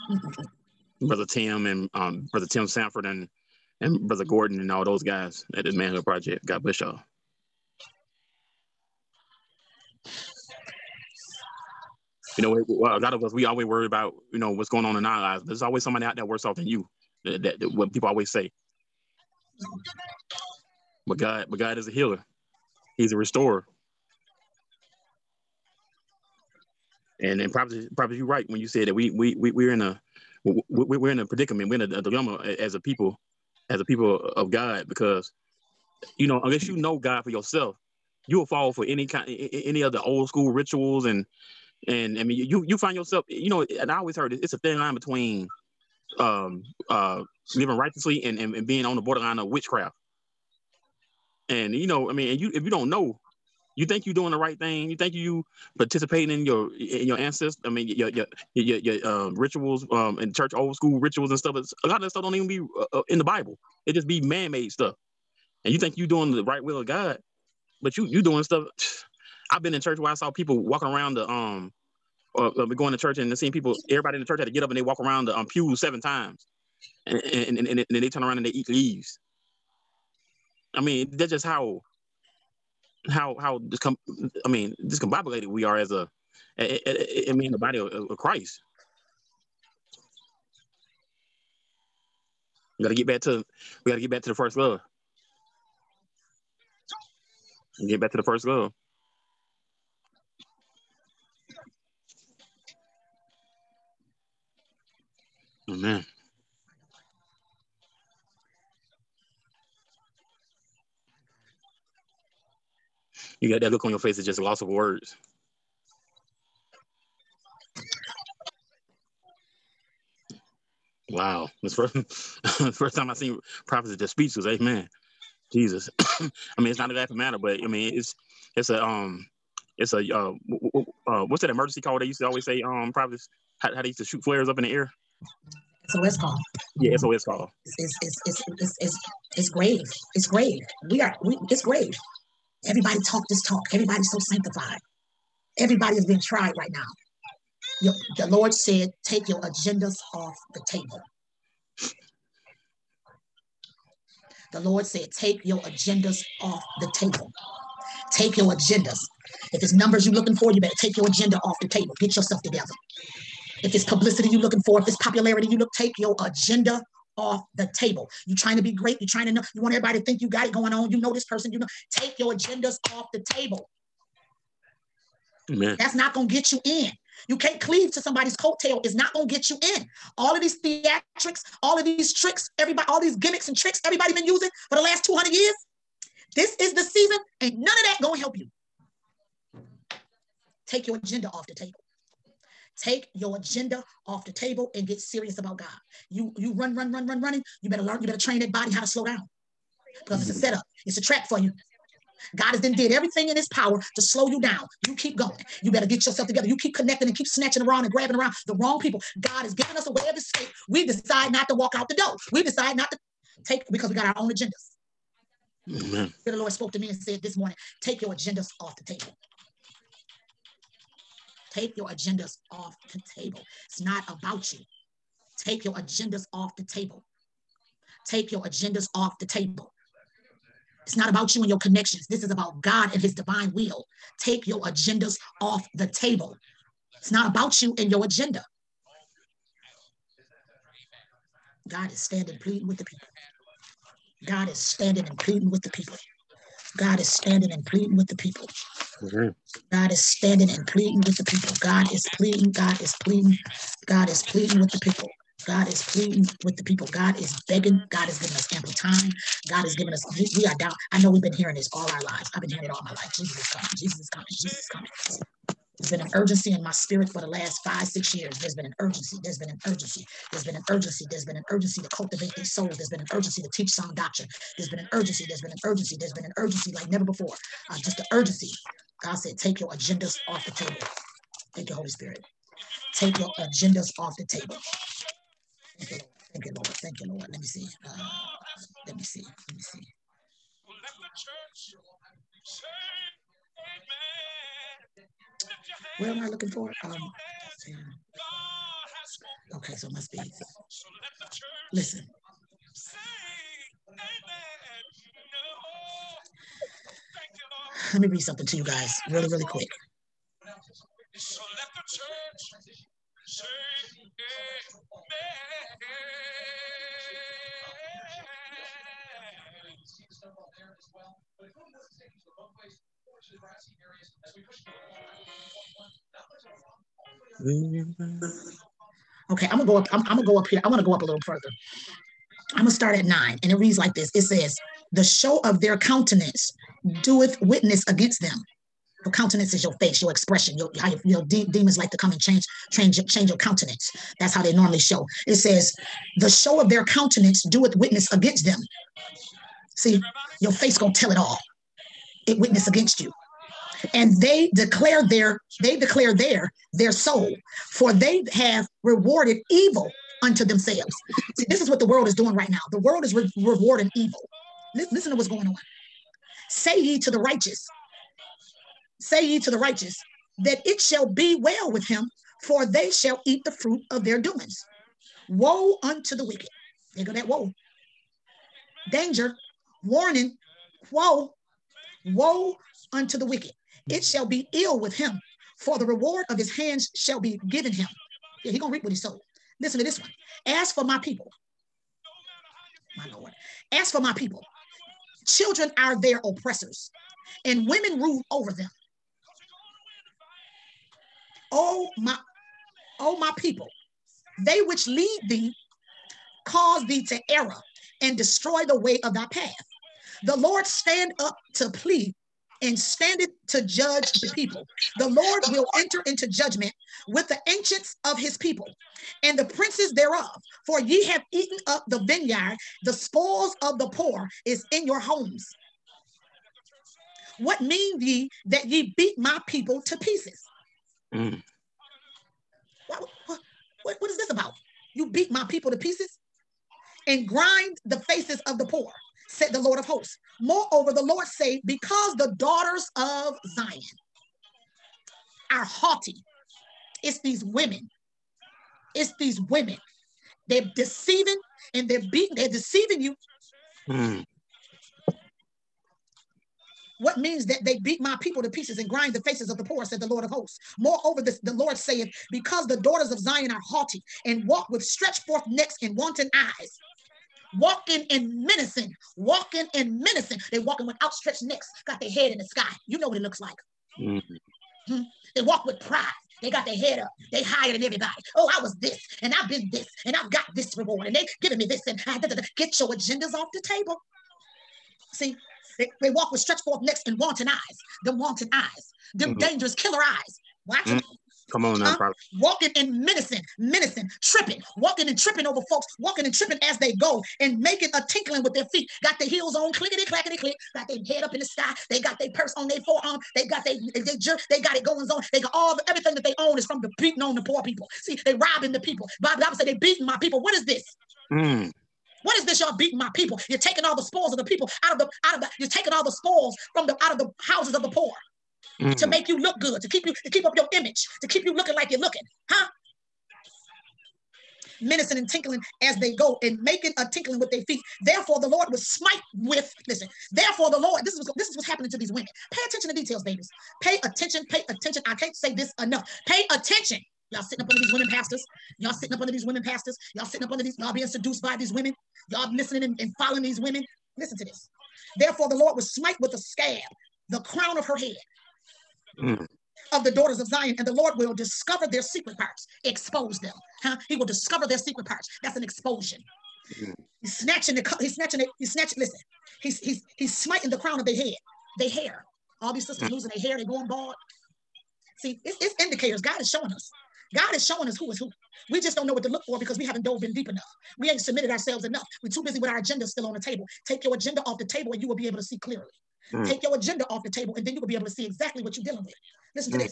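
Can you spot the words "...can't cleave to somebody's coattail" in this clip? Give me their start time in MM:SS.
02:57.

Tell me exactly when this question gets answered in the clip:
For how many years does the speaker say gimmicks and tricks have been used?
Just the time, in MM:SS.
03:05.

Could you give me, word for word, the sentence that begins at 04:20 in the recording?
I know we've been hearing this all our lives.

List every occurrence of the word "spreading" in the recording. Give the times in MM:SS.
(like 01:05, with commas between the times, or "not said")
not said.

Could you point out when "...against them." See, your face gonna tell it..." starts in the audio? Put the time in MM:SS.
05:48.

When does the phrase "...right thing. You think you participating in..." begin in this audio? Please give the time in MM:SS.
00:54.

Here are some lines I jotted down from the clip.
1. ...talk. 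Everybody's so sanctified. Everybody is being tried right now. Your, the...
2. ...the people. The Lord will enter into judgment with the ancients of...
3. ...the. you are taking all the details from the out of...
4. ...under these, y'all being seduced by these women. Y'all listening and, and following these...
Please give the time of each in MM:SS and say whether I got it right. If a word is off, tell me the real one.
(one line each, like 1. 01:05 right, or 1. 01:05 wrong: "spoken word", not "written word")
1. 02:23 right
2. 06:54 right
3. 08:35 wrong: "spoils", not "details"
4. 09:00 right.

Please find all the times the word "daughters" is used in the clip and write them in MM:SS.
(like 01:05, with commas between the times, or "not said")
07:22, 07:42, 09:10.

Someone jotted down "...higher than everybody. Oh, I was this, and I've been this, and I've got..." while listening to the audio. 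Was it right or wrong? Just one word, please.
right.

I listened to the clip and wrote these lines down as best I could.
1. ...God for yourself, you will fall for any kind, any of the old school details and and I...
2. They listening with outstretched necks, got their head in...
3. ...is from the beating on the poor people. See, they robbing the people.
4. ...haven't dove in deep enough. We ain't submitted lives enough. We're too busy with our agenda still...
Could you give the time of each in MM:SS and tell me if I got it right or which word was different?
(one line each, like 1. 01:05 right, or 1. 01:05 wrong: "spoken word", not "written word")
1. 00:36 wrong: "rituals", not "details"
2. 07:50 wrong: "walking", not "listening"
3. 08:26 right
4. 09:29 wrong: "ourselves", not "lives".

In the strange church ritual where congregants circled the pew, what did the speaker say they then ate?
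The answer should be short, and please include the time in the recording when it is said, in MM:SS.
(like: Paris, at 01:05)
leaves, at 01:18.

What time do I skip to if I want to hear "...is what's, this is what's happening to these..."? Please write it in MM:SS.
08:51.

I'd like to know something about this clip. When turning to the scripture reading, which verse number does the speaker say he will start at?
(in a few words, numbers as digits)
9.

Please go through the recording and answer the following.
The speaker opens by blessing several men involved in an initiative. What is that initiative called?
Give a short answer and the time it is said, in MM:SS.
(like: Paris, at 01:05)
manhood project, at 00:05.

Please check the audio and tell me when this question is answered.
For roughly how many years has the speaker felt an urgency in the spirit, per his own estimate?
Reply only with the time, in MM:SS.
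04:27.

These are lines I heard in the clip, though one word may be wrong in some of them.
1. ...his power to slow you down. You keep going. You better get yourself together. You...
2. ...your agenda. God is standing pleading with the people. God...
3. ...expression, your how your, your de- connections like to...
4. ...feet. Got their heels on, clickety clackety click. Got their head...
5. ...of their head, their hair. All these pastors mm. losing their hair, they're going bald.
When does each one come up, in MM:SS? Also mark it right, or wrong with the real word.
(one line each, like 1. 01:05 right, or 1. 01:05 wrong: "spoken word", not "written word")
1. 03:23 right
2. 03:57 right
3. 05:40 wrong: "demons", not "connections"
4. 08:18 right
5. 09:20 wrong: "sisters", not "pastors".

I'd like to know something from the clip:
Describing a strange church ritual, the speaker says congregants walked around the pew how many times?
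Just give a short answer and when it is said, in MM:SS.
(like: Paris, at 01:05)
7, at 01:15.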